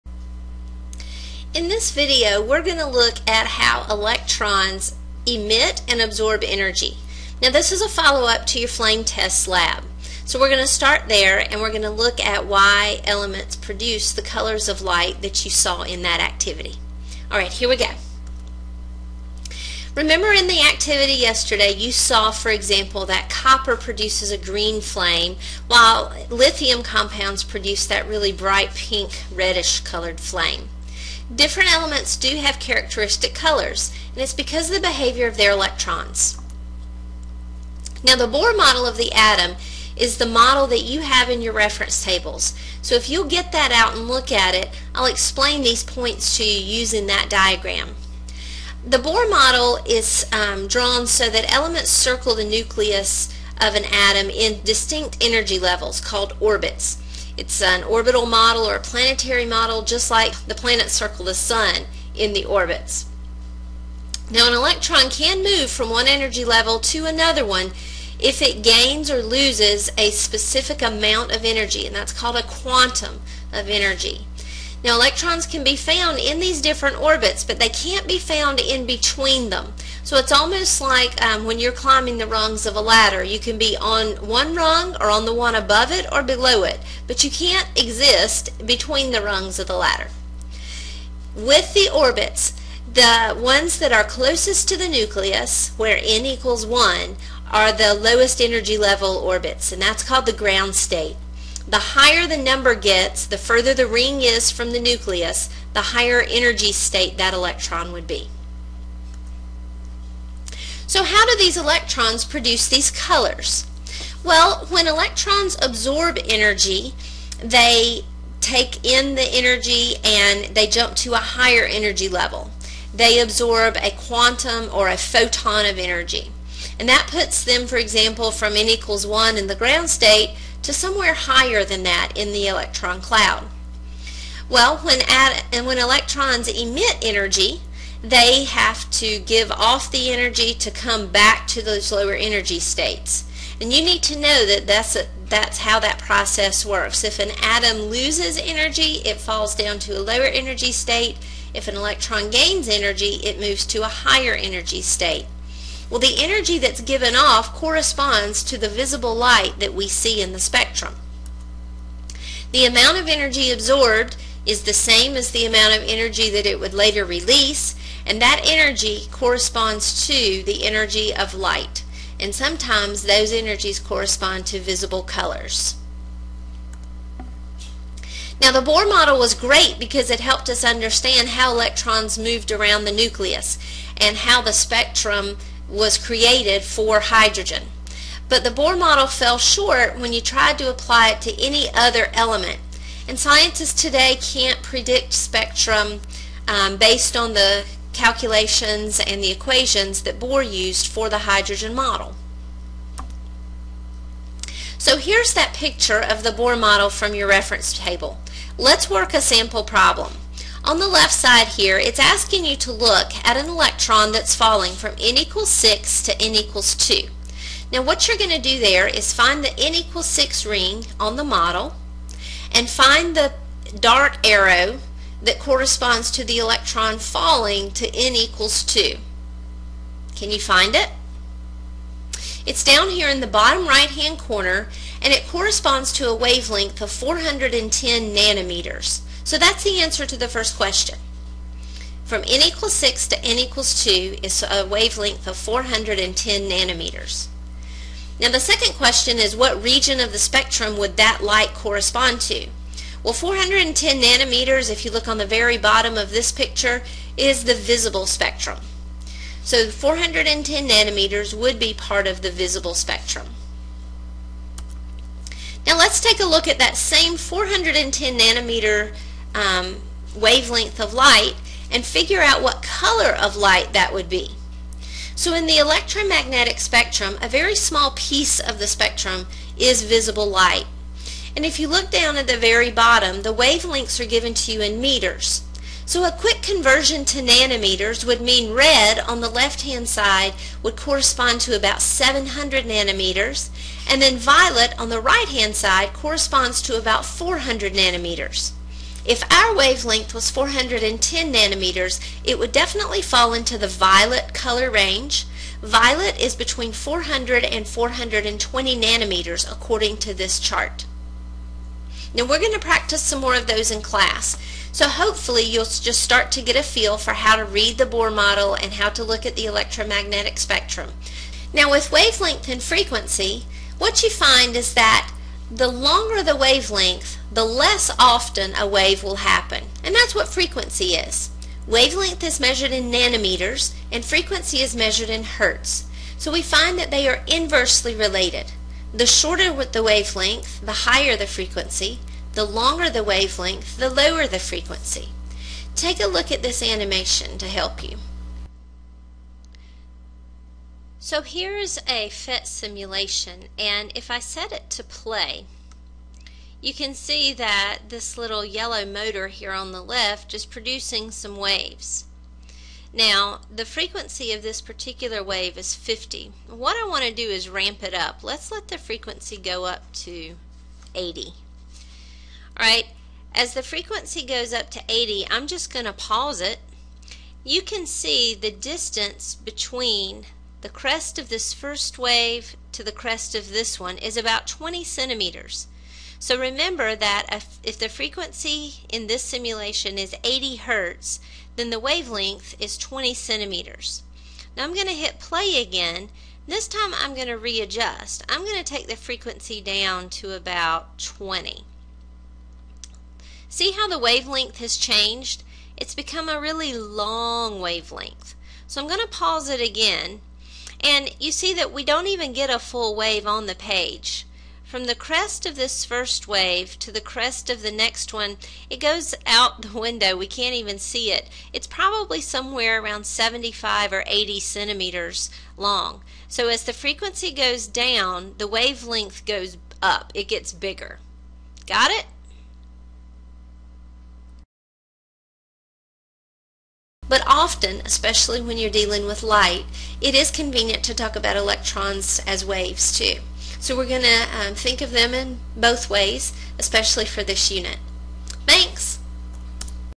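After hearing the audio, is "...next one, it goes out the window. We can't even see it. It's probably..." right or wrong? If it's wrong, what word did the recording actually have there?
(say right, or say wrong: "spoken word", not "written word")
right.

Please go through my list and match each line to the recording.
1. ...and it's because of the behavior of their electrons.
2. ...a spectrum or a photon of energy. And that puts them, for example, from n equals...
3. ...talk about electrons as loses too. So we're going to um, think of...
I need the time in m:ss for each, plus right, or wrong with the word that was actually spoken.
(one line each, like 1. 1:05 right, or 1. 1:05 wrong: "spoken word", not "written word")
1. 0:34 right
2. 2:03 wrong: "quantum", not "spectrum"
3. 7:20 wrong: "waves", not "loses".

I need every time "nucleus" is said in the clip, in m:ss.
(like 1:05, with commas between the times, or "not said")
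0:52, 1:34, 1:44, 3:02.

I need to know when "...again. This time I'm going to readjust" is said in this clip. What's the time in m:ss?
6:35.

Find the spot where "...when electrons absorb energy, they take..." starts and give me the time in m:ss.
1:54.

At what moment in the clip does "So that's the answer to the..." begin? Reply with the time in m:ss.
3:59.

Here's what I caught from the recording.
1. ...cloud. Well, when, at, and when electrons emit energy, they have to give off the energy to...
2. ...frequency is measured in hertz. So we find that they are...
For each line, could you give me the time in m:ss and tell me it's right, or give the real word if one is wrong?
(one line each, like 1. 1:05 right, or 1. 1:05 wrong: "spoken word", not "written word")
1. 2:13 right
2. 5:34 right.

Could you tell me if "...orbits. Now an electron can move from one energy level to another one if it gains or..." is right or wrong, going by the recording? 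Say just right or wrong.
right.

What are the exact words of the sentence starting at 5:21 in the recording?
Now with wavelength and frequency, what you find is that the longer the wavelength, the less often a wave will happen.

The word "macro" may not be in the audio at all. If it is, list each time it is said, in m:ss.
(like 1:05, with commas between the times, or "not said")
not said.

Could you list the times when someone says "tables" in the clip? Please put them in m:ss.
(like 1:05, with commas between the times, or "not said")
0:42, 3:27.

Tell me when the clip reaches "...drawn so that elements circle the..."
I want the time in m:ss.
0:50.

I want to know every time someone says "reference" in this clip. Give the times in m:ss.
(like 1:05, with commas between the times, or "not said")
0:41, 3:27.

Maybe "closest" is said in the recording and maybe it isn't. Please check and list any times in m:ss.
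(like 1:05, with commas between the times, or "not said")
1:34.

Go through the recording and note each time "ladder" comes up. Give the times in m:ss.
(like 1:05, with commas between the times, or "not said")
1:22, 1:29.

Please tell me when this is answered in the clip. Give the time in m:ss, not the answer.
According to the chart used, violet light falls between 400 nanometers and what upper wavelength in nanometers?
5:07.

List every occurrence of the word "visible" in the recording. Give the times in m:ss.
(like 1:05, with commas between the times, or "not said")
2:38, 2:54, 4:17, 4:22, 4:39.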